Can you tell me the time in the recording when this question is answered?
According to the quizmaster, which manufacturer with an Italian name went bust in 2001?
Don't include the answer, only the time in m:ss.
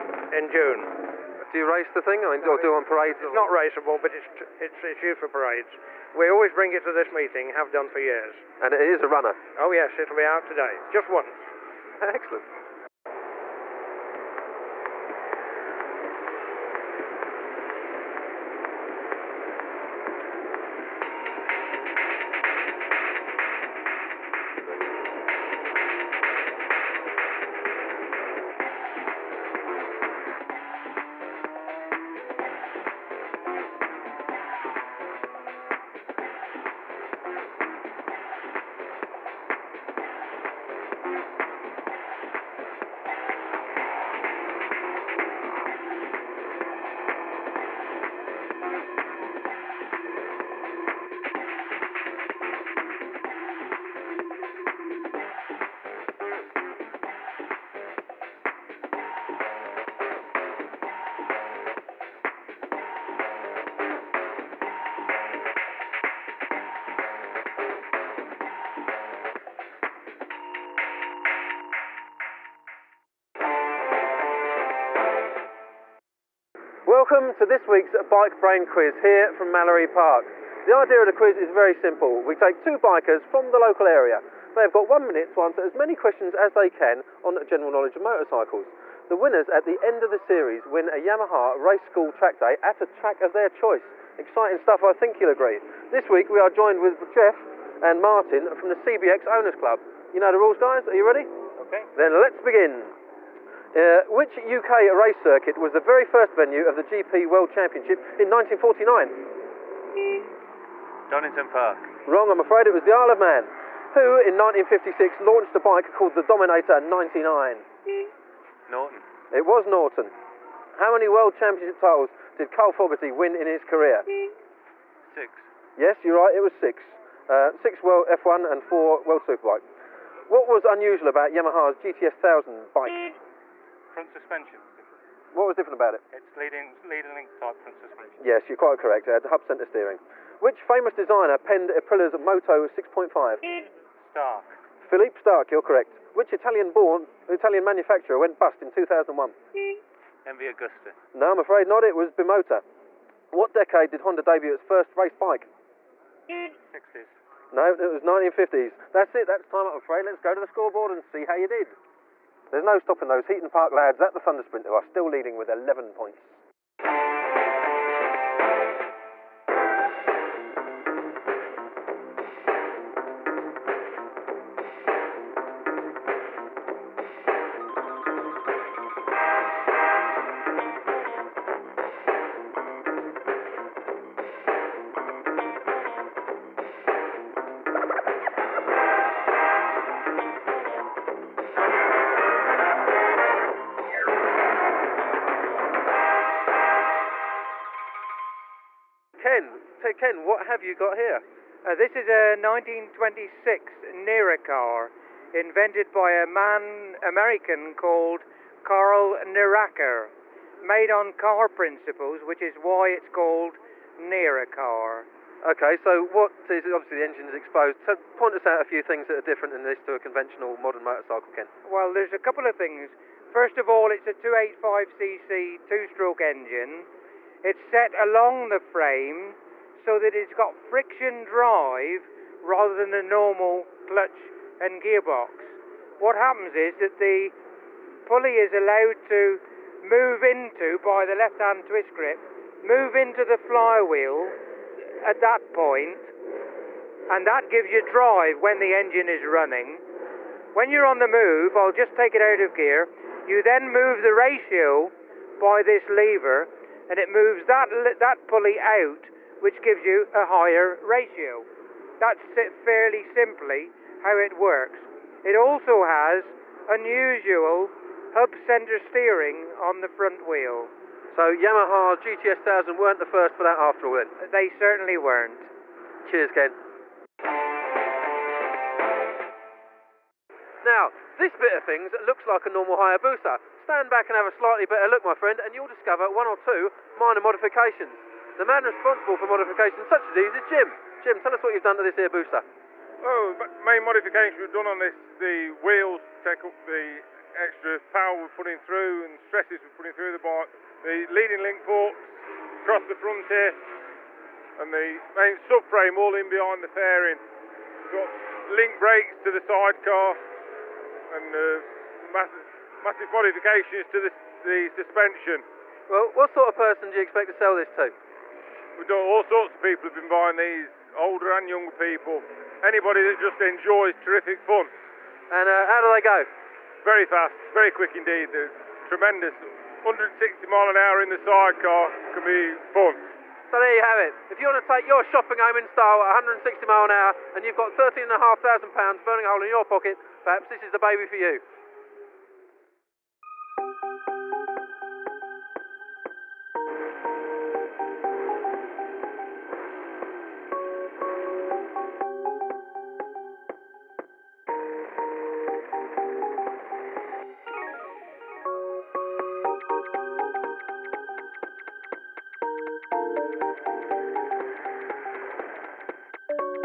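2:32.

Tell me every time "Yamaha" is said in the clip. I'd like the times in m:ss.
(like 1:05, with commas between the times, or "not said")
1:30, 2:11, 4:31.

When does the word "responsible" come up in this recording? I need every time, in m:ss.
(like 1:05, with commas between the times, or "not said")
4:48.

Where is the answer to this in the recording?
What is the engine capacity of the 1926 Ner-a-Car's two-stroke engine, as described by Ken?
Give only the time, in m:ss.
3:44.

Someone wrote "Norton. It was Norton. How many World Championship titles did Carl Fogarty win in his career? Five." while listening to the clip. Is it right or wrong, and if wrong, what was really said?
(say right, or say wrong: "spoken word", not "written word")
wrong: "Six", not "Five".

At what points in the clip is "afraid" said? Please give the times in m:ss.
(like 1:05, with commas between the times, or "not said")
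1:52, 2:31, 2:39.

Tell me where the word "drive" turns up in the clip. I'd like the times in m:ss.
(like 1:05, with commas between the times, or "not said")
3:51, 4:07.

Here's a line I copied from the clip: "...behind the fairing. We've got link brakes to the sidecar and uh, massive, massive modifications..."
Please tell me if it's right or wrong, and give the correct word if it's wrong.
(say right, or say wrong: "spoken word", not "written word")
right.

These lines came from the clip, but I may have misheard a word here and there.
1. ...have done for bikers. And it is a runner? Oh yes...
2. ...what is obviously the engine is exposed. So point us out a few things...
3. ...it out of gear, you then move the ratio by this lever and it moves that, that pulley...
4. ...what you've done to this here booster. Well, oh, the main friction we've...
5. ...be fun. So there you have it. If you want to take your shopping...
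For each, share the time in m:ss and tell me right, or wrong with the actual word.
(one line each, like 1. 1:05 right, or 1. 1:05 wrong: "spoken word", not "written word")
1. 0:07 wrong: "years", not "bikers"
2. 3:36 right
3. 4:12 right
4. 4:51 wrong: "modification", not "friction"
5. 5:32 right.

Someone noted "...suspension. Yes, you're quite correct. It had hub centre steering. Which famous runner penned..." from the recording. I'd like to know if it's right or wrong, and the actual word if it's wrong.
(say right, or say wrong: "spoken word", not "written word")
wrong: "designer", not "runner".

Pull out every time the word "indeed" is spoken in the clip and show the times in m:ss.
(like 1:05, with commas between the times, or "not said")
5:27.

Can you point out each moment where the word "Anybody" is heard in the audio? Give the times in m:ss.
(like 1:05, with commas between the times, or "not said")
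5:22.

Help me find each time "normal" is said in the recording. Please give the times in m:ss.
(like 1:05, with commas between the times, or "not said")
3:53, 4:42.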